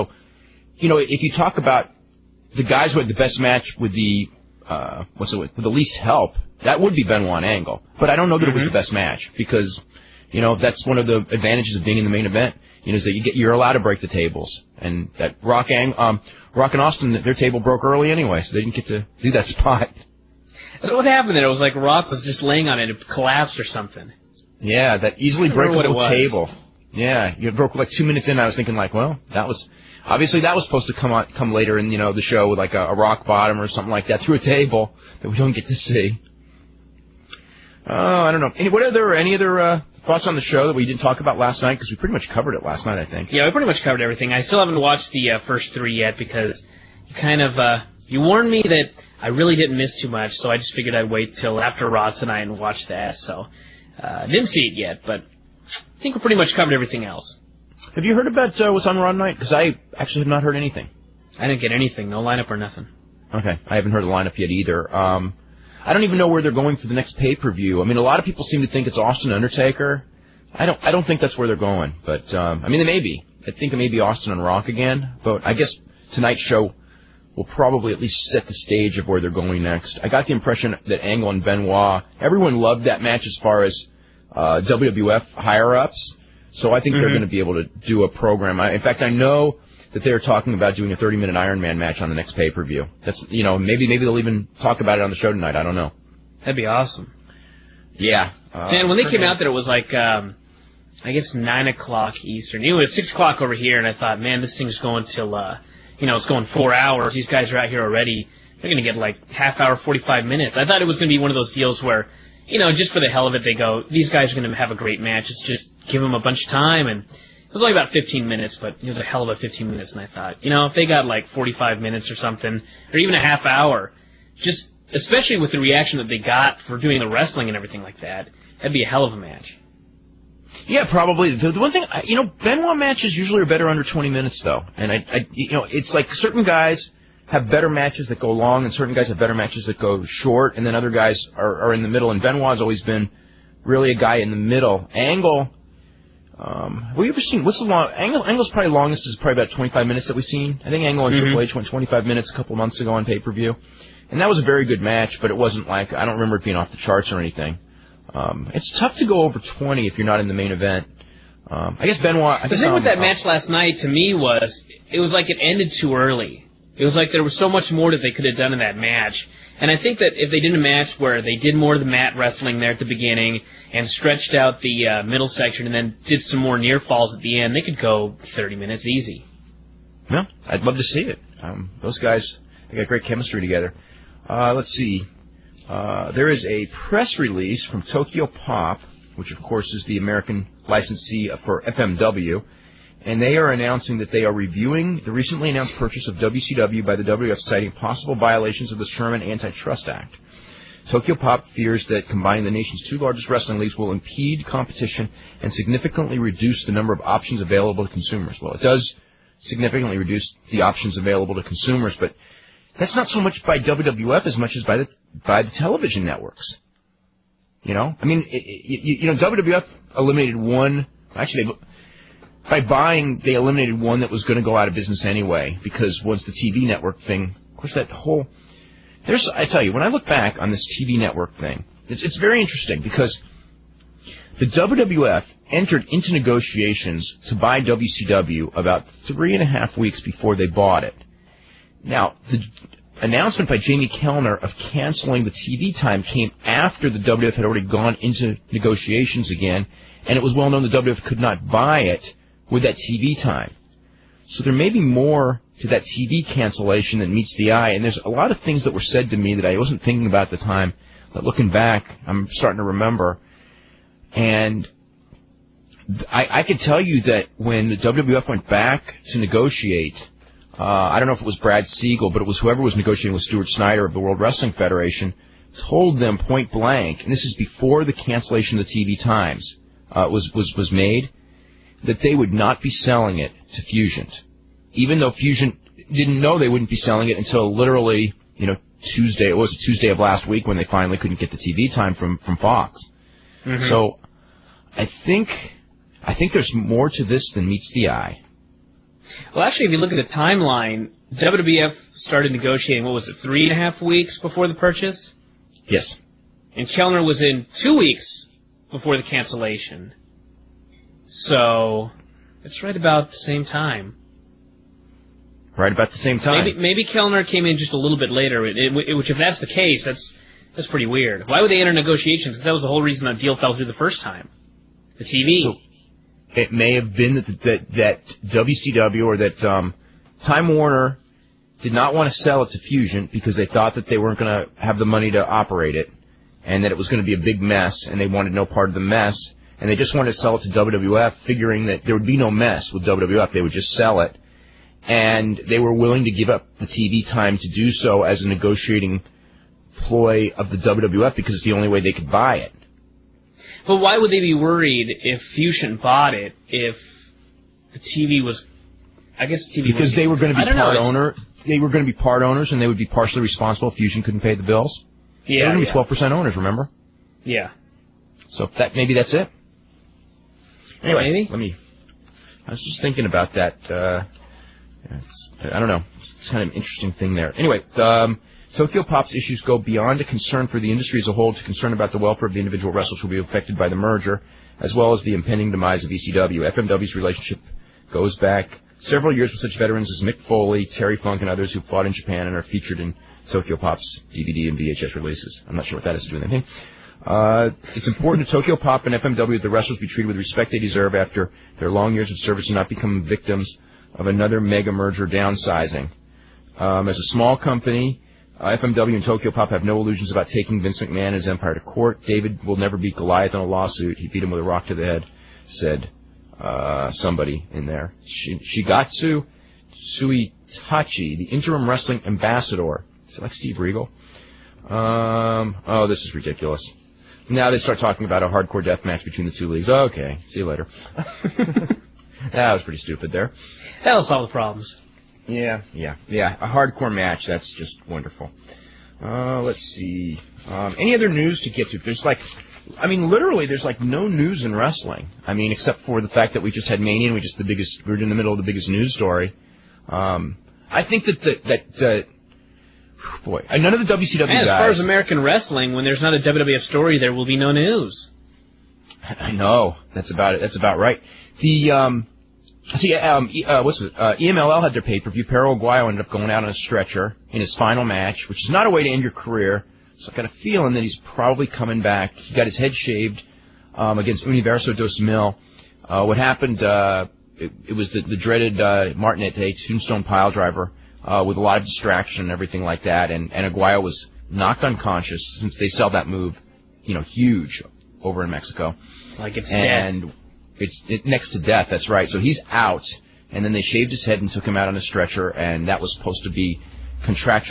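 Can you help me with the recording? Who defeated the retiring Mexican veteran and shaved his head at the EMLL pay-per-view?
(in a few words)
Universo 2000.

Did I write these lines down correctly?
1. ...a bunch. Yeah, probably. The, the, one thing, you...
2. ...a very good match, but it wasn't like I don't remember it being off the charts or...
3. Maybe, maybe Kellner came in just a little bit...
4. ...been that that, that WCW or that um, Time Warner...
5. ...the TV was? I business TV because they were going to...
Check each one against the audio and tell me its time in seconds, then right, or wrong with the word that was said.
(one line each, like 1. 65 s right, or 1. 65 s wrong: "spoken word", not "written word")
1. 129 s wrong: "match", not "bunch"
2. 154 s right
3. 316 s right
4. 326 s right
5. 357 s wrong: "guess", not "business".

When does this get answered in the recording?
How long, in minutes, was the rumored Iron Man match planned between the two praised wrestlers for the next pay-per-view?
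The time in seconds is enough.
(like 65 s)
90 s.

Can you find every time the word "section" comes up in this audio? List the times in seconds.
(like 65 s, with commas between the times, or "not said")
175 s.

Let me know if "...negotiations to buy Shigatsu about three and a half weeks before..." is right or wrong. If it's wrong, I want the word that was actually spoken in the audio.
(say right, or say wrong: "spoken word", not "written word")
wrong: "WCW", not "Shigatsu".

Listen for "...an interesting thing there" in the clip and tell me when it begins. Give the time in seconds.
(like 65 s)
376 s.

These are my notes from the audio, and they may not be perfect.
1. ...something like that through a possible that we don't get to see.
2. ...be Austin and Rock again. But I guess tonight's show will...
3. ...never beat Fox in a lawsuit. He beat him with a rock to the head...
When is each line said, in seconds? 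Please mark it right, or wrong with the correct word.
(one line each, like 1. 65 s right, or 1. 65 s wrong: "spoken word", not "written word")
1. 33 s wrong: "table", not "possible"
2. 73 s right
3. 412 s wrong: "Goliath", not "Fox".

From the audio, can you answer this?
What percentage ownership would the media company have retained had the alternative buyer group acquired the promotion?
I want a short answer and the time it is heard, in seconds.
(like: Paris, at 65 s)
12%, at 365 s.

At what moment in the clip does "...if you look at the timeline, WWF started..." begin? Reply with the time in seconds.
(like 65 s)
299 s.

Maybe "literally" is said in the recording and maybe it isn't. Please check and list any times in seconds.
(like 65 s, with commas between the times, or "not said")
287 s, 443 s.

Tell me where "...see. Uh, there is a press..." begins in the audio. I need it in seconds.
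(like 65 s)
184 s.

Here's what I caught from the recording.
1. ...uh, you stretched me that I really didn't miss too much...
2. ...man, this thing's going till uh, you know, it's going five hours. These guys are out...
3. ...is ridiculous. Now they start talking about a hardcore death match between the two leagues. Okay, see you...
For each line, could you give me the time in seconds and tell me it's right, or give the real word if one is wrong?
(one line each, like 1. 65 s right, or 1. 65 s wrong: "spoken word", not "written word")
1. 47 s wrong: "warned", not "stretched"
2. 104 s wrong: "four", not "five"
3. 426 s right.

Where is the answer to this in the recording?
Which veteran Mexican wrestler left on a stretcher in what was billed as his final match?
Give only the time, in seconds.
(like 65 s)
465 s.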